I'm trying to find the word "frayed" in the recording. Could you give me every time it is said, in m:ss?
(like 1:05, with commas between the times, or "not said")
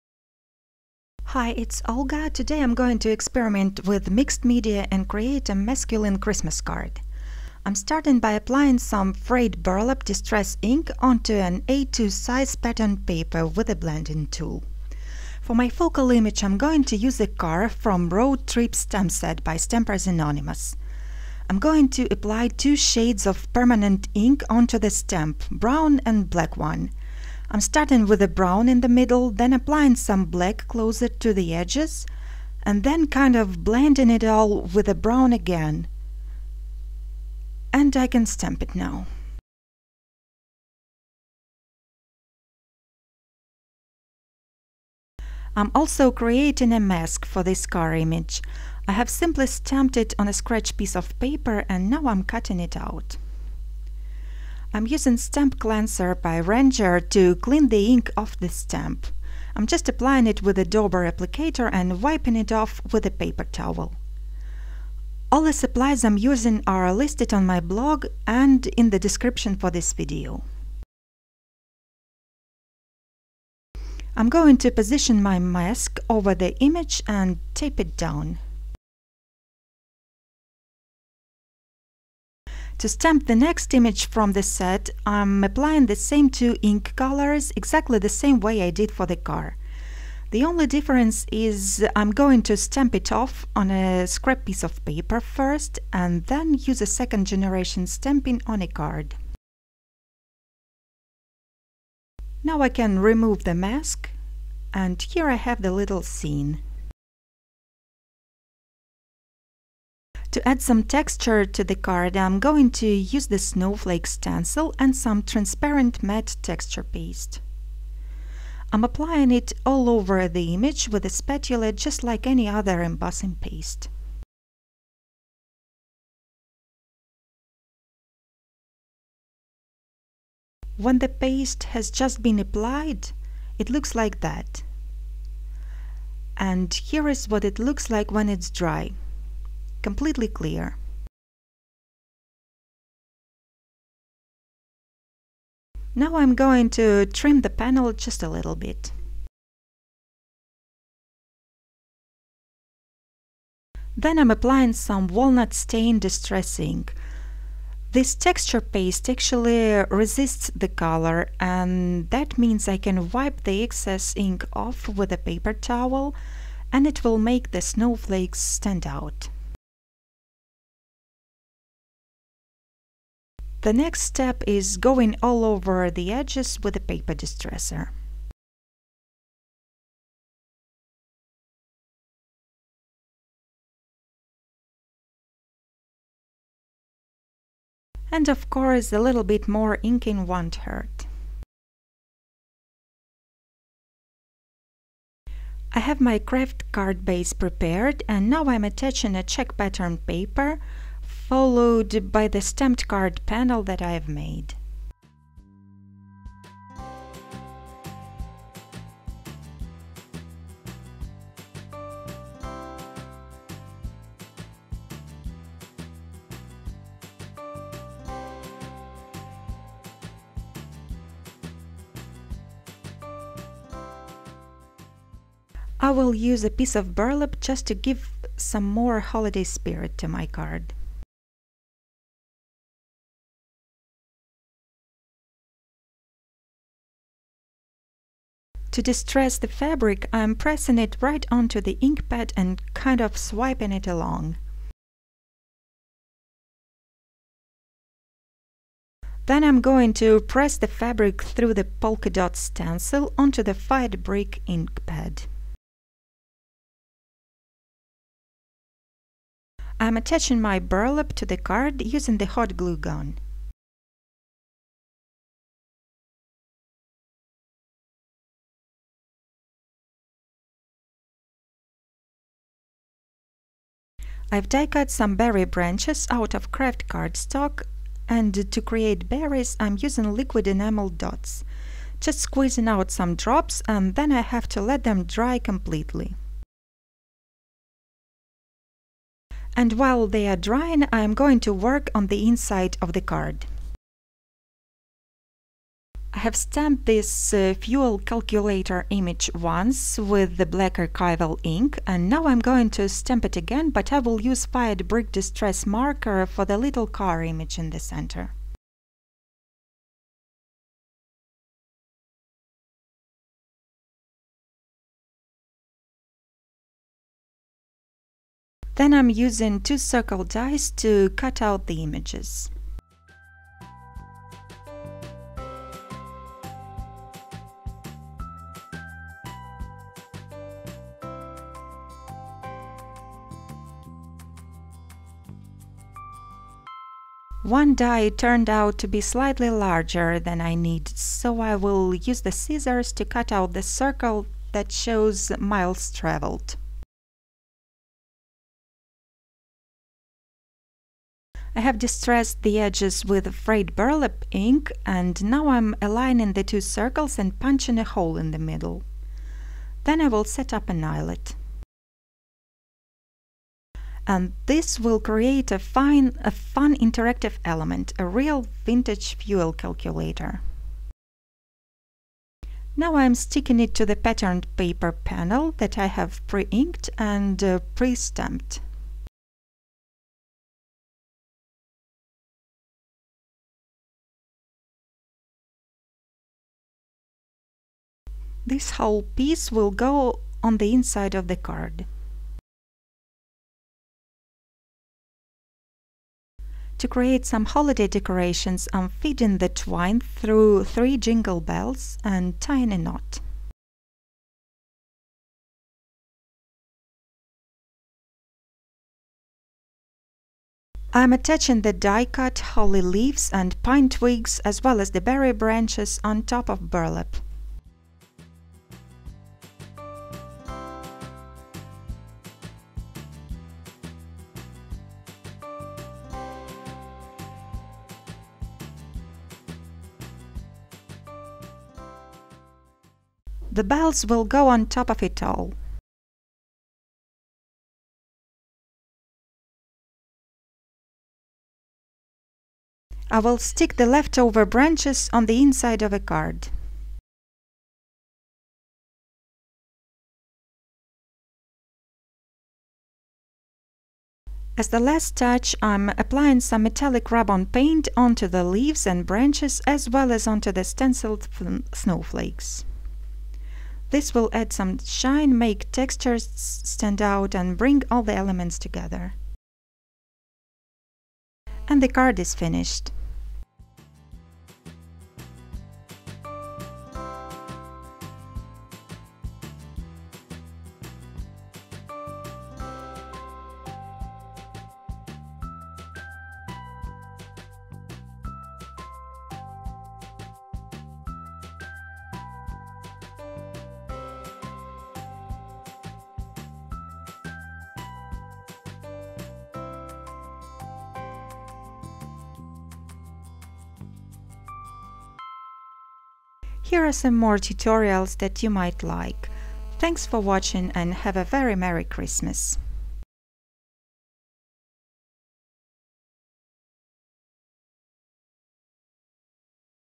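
0:09, 5:53.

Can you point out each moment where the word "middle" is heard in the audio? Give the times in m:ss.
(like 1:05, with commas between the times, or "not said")
0:28, 5:58.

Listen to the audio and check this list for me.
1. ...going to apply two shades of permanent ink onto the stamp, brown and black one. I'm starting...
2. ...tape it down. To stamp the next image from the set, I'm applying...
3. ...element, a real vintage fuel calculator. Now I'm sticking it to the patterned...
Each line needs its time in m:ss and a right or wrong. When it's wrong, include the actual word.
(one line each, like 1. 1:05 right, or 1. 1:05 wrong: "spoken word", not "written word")
1. 0:21 right
2. 1:17 right
3. 6:07 right.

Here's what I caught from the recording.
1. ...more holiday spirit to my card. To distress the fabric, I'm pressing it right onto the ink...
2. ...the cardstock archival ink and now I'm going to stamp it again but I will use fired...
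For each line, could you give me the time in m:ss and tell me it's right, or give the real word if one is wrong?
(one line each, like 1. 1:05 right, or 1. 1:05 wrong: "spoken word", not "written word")
1. 3:48 right
2. 5:00 wrong: "black", not "cardstock".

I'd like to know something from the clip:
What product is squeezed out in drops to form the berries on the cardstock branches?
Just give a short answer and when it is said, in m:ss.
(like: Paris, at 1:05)
liquid enamel dots, at 4:40.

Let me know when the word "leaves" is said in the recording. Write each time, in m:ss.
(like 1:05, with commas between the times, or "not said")
6:52, 7:38.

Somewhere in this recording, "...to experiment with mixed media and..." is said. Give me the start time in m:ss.
0:02.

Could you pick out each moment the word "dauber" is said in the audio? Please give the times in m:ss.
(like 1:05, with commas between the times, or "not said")
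1:00.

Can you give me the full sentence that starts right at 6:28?
This whole piece will go on the inside of the card.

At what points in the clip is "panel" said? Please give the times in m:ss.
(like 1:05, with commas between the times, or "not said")
2:27, 3:23, 6:14.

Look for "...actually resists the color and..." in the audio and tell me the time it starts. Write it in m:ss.
2:39.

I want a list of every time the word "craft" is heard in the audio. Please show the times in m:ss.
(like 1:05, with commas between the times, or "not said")
3:16, 4:36.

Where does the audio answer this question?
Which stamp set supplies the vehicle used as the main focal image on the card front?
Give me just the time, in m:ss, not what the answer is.
0:18.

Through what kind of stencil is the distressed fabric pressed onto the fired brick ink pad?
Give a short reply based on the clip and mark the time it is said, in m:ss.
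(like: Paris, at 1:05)
polka dot, at 4:11.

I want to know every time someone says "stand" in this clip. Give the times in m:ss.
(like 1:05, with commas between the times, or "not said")
2:48, 7:46.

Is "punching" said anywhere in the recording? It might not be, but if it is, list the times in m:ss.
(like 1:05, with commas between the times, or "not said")
5:57.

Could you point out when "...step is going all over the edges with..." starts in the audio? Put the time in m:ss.
2:54.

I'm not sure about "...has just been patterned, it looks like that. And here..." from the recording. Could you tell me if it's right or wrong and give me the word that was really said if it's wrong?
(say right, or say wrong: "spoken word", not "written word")
wrong: "applied", not "patterned".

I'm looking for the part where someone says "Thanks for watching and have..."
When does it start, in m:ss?
8:29.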